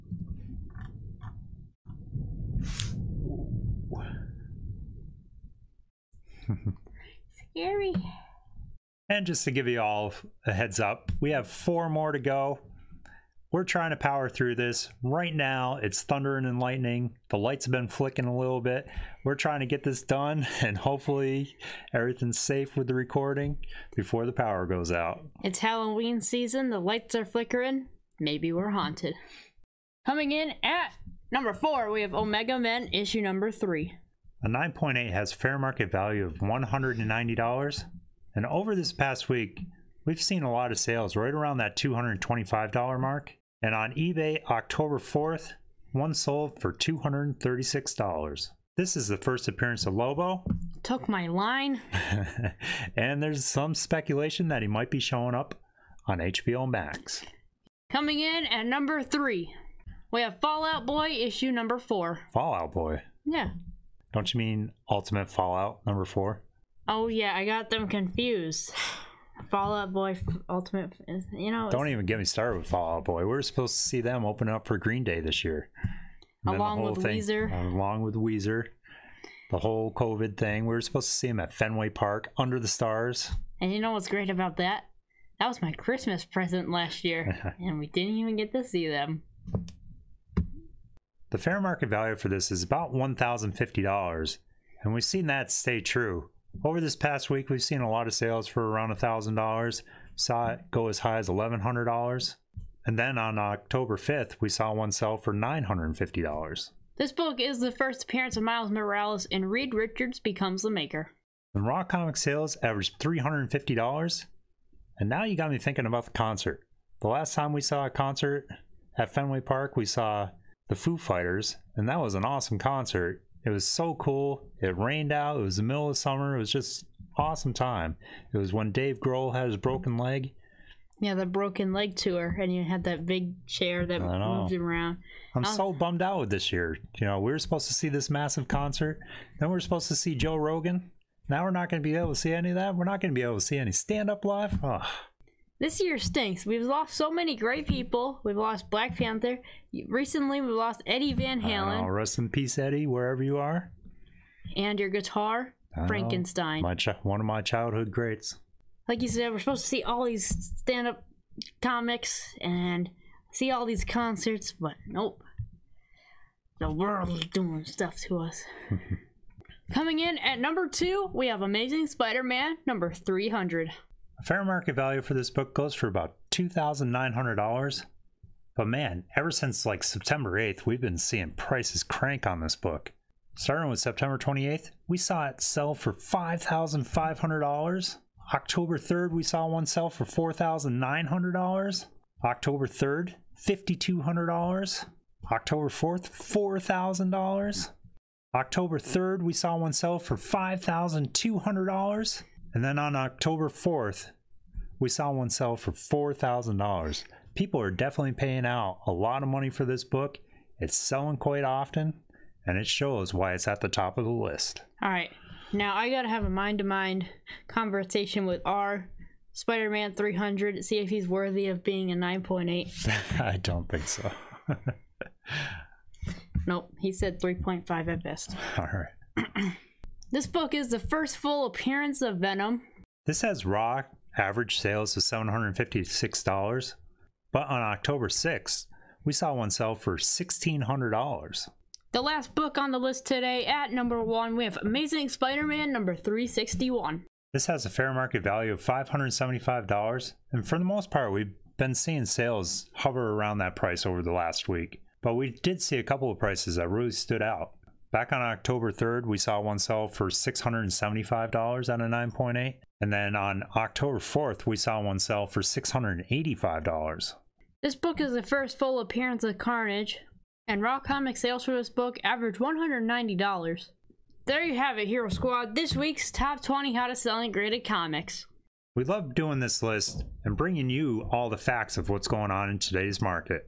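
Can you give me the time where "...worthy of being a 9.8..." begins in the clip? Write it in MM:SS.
03:41.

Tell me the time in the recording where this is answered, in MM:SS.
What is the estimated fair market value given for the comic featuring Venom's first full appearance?
02:56.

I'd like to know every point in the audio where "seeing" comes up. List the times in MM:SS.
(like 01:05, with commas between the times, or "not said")
03:00, 04:11.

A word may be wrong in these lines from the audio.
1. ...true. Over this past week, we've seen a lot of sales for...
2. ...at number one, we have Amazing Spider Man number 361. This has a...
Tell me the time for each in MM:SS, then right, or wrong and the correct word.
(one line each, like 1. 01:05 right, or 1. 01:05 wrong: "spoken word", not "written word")
1. 01:35 right
2. 04:03 right.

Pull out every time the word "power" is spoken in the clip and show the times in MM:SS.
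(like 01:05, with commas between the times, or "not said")
00:13, 00:24.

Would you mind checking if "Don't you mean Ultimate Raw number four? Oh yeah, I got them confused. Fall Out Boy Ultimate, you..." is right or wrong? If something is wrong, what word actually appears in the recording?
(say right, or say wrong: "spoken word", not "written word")
wrong: "Fallout", not "Raw".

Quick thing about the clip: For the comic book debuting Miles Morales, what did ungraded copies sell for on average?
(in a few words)
$350.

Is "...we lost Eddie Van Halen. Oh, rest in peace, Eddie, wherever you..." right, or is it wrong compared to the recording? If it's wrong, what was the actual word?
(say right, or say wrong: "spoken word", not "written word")
right.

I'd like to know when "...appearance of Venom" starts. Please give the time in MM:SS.
03:51.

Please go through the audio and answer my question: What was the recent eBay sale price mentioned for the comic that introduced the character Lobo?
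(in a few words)
$236.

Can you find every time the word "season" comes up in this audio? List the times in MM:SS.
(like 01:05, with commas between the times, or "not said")
00:26.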